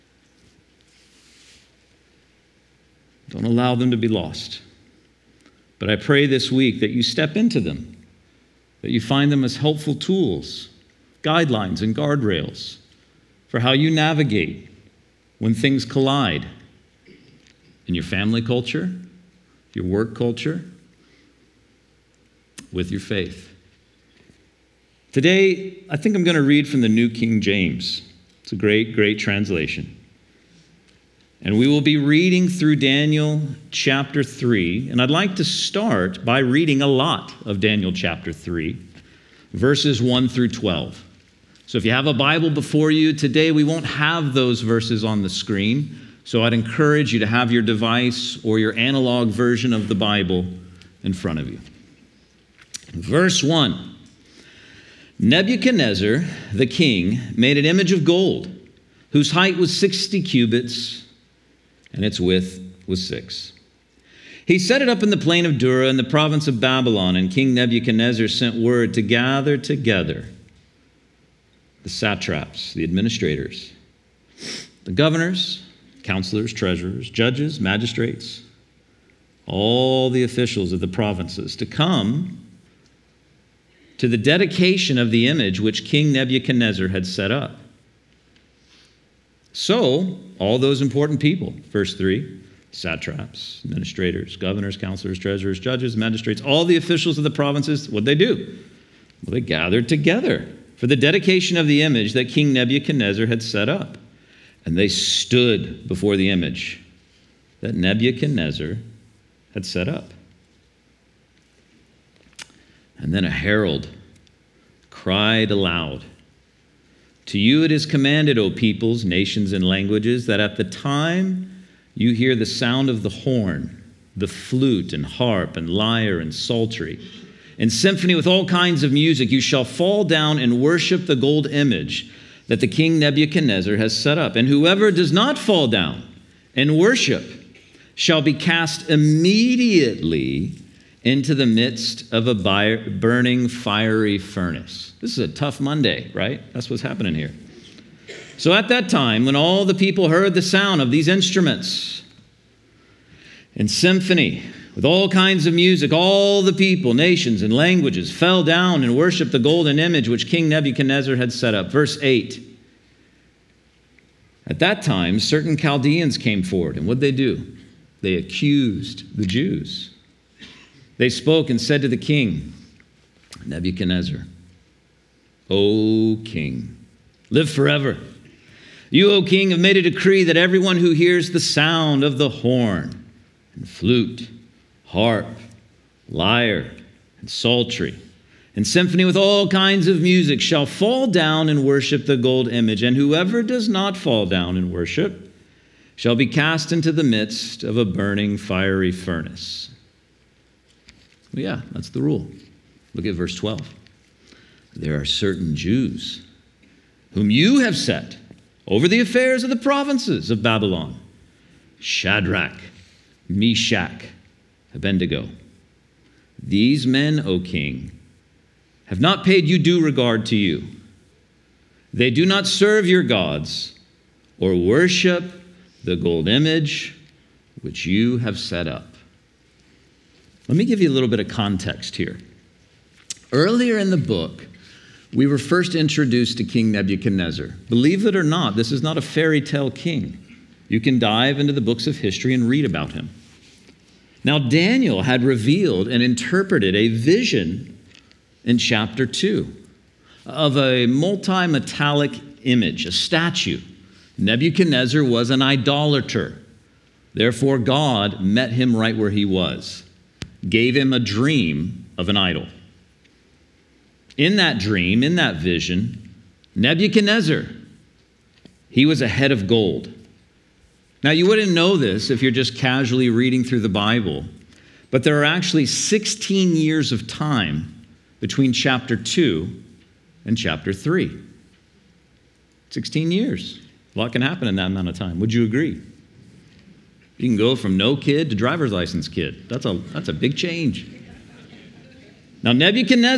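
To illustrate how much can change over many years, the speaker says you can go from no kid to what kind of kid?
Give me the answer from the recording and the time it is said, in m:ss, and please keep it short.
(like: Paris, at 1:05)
driver's license kid, at 4:48.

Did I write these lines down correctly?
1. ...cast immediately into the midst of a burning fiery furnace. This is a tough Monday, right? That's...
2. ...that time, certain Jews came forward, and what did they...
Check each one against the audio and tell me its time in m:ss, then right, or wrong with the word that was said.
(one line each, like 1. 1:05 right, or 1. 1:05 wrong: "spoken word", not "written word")
1. 2:18 right
2. 2:44 wrong: "Chaldeans", not "Jews".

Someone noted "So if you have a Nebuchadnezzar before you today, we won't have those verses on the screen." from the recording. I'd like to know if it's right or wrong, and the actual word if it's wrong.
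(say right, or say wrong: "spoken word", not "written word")
wrong: "Bible", not "Nebuchadnezzar".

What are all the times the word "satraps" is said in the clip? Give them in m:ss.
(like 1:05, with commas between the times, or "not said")
1:11, 1:32.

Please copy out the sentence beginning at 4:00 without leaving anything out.
You can dive into the books of history and read about him.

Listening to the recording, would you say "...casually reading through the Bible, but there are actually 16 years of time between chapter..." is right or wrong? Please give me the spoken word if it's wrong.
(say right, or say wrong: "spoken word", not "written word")
right.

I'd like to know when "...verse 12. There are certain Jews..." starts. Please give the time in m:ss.
3:23.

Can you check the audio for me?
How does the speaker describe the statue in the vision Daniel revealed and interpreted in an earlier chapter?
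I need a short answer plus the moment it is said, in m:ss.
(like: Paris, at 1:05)
multi metallic, at 4:10.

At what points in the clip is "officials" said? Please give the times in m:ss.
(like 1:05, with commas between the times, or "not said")
1:20, 1:36.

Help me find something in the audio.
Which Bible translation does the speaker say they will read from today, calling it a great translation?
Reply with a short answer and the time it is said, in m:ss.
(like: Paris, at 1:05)
New King James, at 0:26.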